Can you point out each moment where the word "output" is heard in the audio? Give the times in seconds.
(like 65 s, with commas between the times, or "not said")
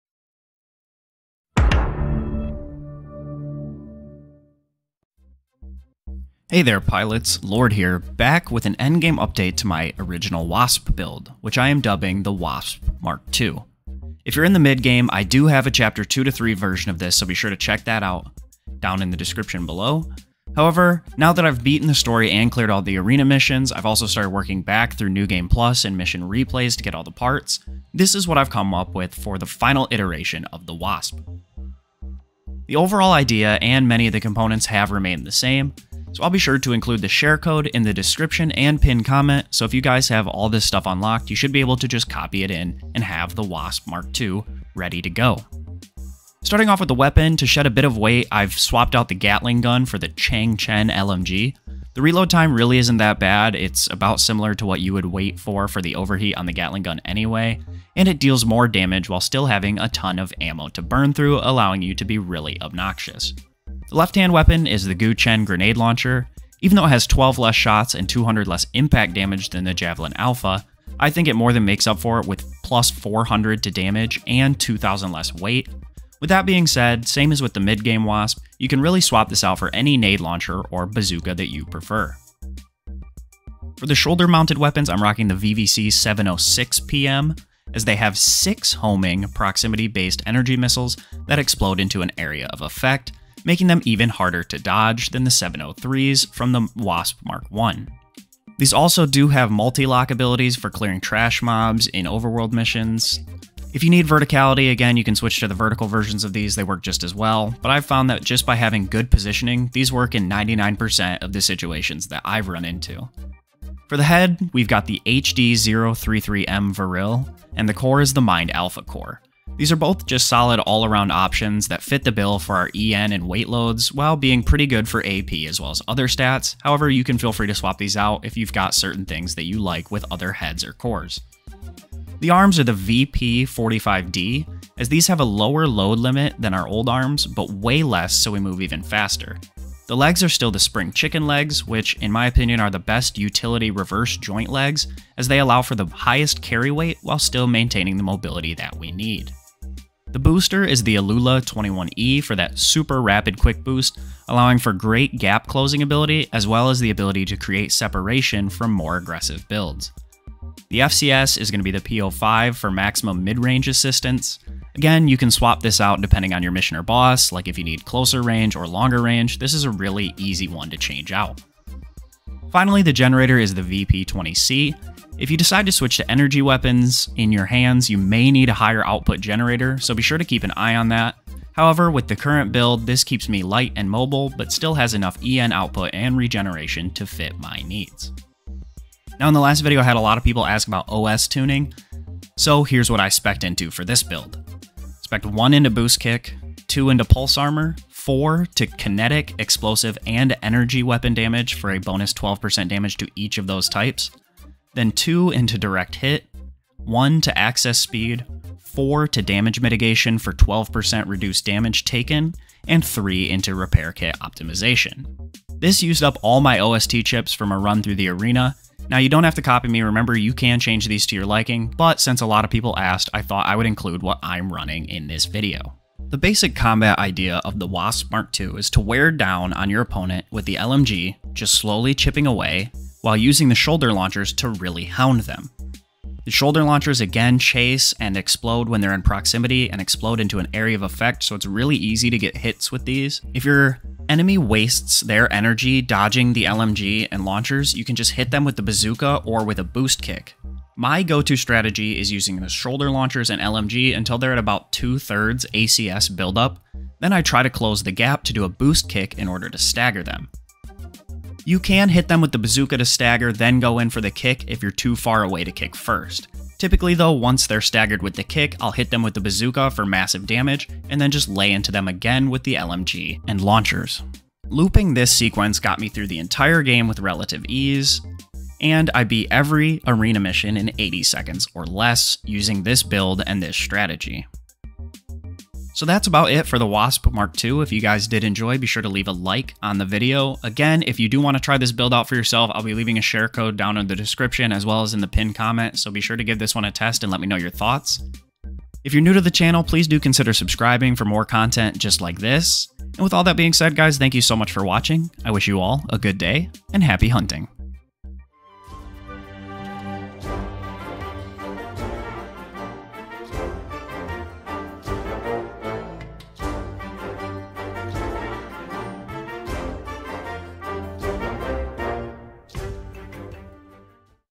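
178 s, 185 s.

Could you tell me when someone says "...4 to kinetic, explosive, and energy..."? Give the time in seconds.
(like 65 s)
197 s.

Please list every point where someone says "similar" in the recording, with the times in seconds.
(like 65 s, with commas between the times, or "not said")
54 s.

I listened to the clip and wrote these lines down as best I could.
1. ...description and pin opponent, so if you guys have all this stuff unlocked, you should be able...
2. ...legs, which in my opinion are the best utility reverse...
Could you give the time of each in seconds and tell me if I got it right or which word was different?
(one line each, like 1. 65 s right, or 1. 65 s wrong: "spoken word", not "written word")
1. 37 s wrong: "comment", not "opponent"
2. 141 s right.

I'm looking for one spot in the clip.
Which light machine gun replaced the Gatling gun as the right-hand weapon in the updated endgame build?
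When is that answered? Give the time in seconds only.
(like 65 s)
50 s.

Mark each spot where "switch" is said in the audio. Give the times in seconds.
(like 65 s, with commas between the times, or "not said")
105 s, 175 s.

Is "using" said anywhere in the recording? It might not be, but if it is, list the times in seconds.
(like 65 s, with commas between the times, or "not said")
233 s, 252 s, 282 s.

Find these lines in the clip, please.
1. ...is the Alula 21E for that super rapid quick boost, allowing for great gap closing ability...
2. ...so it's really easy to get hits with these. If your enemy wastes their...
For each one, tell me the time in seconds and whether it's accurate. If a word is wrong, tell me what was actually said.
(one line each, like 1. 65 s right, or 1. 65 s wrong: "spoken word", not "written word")
1. 150 s right
2. 241 s right.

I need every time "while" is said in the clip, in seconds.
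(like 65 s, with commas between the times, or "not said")
59 s, 123 s, 147 s, 233 s.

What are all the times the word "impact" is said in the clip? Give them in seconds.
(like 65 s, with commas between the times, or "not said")
68 s.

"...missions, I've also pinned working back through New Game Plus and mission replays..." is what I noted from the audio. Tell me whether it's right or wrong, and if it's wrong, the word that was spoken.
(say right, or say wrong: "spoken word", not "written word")
wrong: "started", not "pinned".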